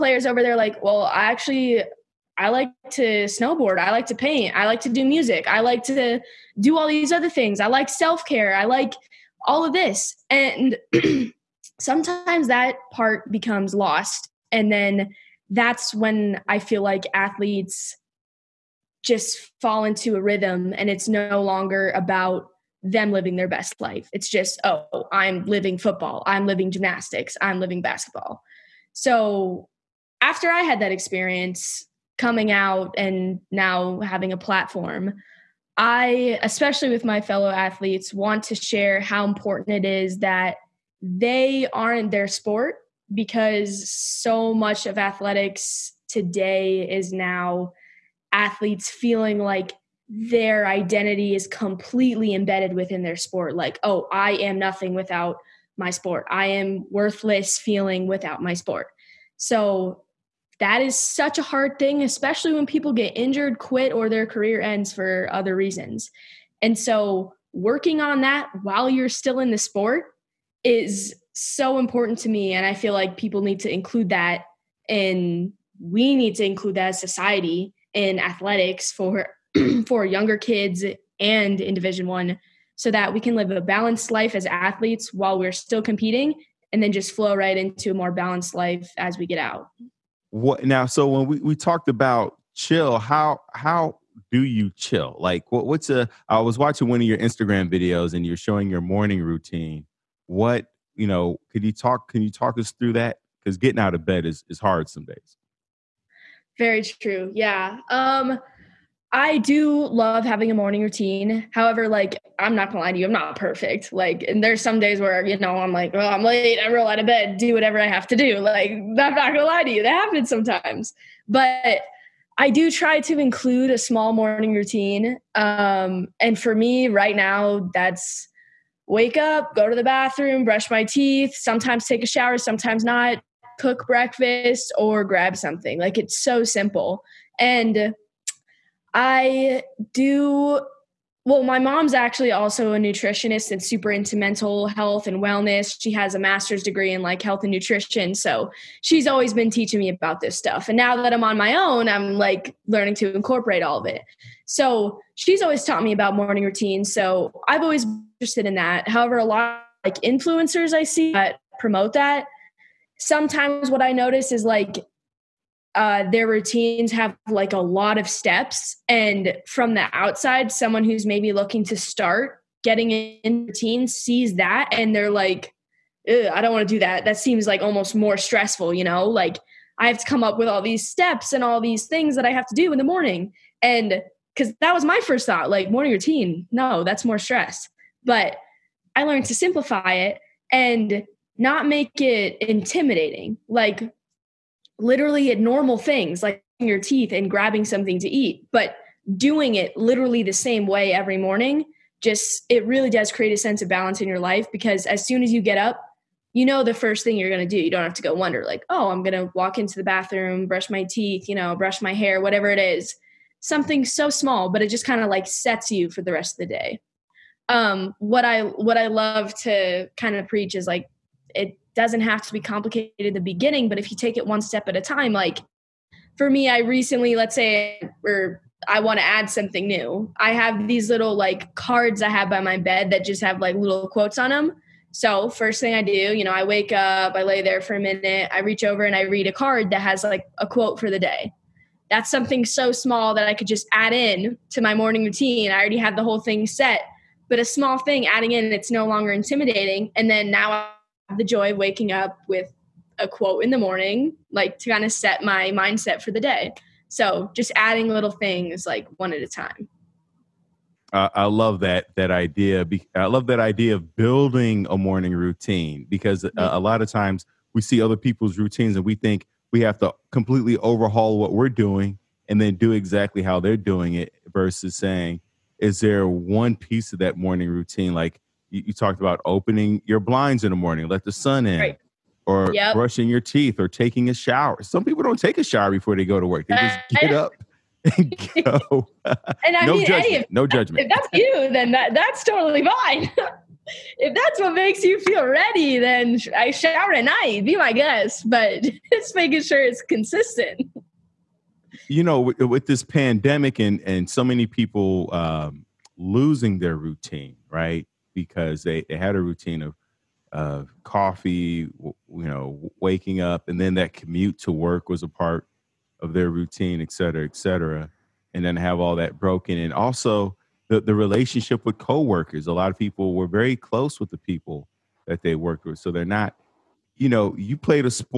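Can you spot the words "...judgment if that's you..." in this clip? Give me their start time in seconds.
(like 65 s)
290 s.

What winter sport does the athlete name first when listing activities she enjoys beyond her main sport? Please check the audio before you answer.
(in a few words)
Snowboard.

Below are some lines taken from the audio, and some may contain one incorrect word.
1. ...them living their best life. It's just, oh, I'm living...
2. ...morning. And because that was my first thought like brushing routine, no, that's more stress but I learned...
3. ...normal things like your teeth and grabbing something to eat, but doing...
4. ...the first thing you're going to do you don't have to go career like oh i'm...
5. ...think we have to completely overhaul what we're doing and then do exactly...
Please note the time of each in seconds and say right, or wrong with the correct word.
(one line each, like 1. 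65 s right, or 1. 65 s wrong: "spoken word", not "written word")
1. 22 s right
2. 182 s wrong: "morning", not "brushing"
3. 195 s right
4. 206 s wrong: "wonder", not "career"
5. 268 s right.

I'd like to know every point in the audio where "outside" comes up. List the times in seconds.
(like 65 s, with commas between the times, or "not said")
169 s.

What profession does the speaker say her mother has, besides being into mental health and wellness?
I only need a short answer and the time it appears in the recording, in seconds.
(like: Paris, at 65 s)
Nutritionist, at 142 s.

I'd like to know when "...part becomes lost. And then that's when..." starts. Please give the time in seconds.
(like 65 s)
12 s.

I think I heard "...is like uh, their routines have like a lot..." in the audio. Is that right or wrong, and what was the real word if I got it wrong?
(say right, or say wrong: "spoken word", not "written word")
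right.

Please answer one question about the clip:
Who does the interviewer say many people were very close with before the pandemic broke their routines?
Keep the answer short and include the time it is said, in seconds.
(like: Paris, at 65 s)
Coworkers, at 321 s.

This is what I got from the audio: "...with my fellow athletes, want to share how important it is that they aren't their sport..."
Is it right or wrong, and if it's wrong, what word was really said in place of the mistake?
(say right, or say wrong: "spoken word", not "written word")
right.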